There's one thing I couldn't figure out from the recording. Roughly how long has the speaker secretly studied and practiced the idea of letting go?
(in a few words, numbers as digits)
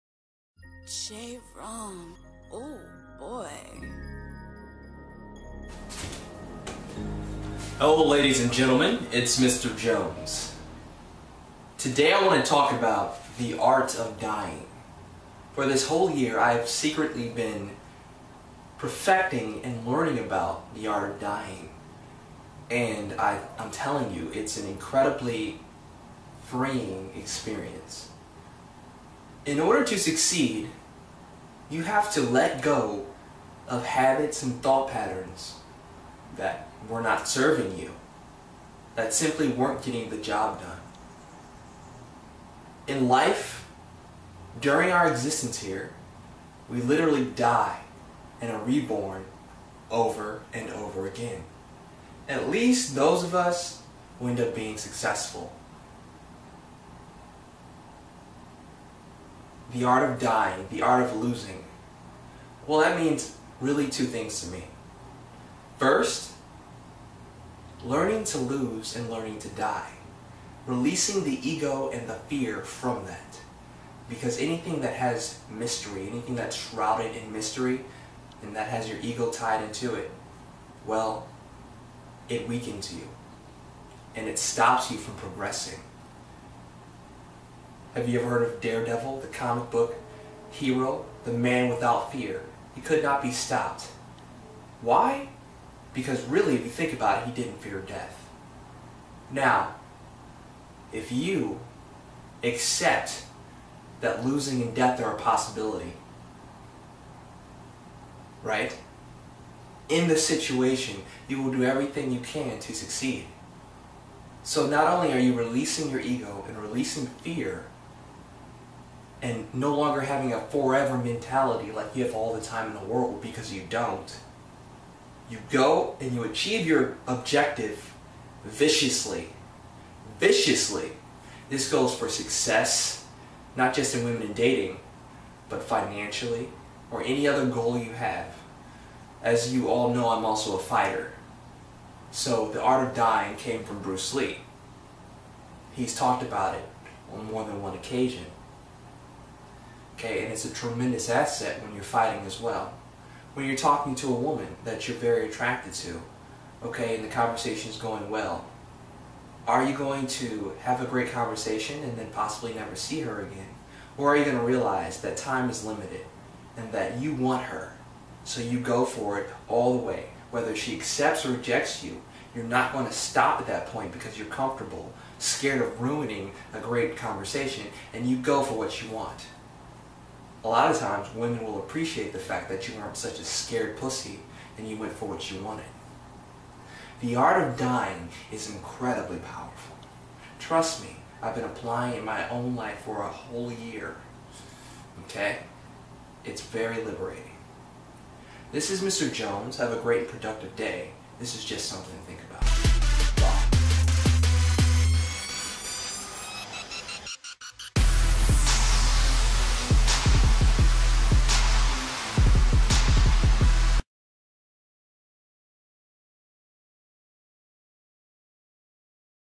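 a whole year.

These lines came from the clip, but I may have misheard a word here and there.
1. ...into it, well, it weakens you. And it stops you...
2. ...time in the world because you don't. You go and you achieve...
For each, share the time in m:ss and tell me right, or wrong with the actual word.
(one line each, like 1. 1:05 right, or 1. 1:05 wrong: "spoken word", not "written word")
1. 1:19 right
2. 2:02 right.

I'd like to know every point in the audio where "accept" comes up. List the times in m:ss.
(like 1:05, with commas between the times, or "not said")
1:42, 2:50.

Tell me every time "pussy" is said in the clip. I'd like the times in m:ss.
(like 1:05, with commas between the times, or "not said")
3:03.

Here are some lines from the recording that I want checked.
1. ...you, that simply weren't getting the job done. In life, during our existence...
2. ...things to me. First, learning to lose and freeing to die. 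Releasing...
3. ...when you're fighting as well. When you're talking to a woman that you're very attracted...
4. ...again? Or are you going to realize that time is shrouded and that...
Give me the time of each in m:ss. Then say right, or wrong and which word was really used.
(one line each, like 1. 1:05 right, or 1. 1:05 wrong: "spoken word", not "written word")
1. 0:37 right
2. 1:04 wrong: "learning", not "freeing"
3. 2:31 right
4. 2:43 wrong: "limited", not "shrouded".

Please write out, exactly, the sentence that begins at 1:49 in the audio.
In the situation, you will do everything you can to succeed.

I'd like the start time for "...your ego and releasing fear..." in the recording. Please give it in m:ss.
1:55.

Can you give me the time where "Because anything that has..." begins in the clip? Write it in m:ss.
1:14.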